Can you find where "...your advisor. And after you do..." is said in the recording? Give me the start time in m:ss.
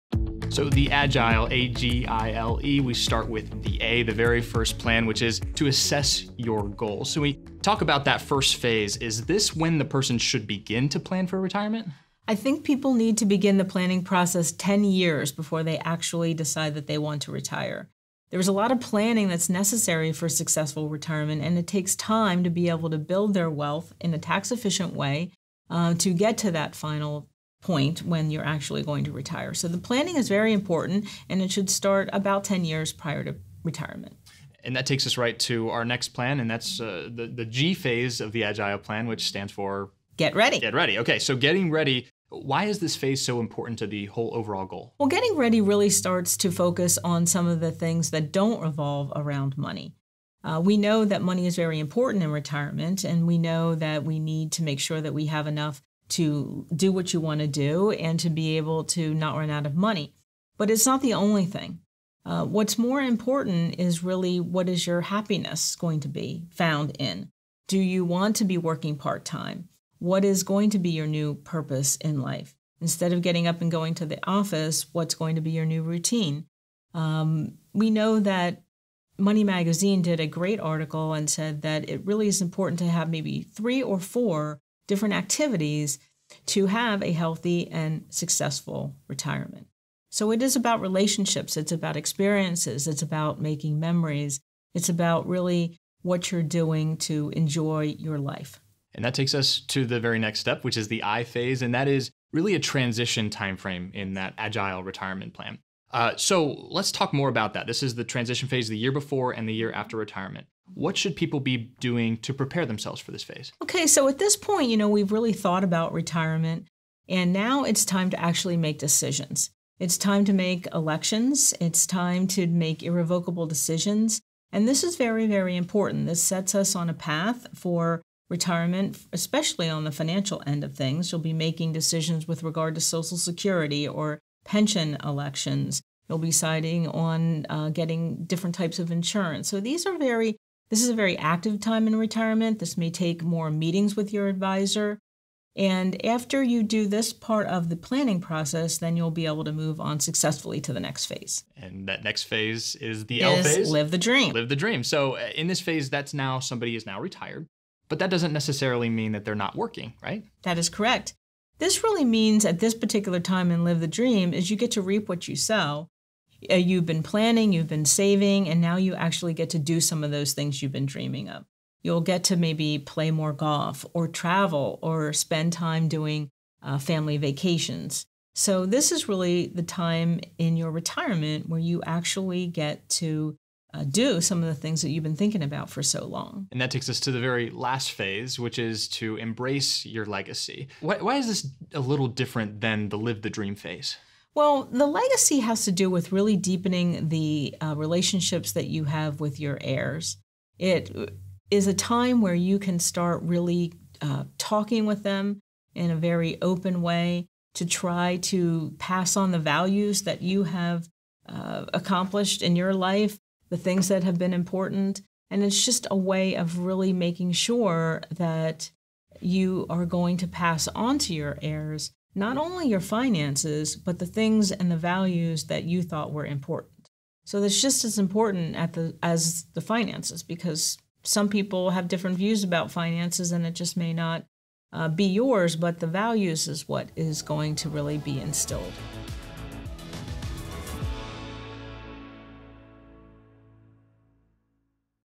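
2:24.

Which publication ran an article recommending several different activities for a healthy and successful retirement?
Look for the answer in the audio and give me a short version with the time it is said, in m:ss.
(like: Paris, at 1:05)
Money Magazine, at 1:19.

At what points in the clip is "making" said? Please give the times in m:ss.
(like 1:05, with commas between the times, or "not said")
1:33, 2:11, 3:36.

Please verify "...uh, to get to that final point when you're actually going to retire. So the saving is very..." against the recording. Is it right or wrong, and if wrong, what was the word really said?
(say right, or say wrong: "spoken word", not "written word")
wrong: "planning", not "saving".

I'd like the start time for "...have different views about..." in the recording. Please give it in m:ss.
3:51.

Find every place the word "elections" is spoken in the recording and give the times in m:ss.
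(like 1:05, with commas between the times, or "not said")
2:00, 2:15.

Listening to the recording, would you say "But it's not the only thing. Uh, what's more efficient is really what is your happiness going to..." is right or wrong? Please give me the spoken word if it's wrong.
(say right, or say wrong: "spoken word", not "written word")
wrong: "important", not "efficient".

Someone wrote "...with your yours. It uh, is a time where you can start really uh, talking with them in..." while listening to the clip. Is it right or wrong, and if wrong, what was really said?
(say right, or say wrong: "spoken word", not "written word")
wrong: "heirs", not "yours".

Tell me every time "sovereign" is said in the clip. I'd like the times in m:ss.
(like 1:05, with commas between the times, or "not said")
not said.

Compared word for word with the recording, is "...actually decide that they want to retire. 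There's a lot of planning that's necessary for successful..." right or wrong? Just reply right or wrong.
right.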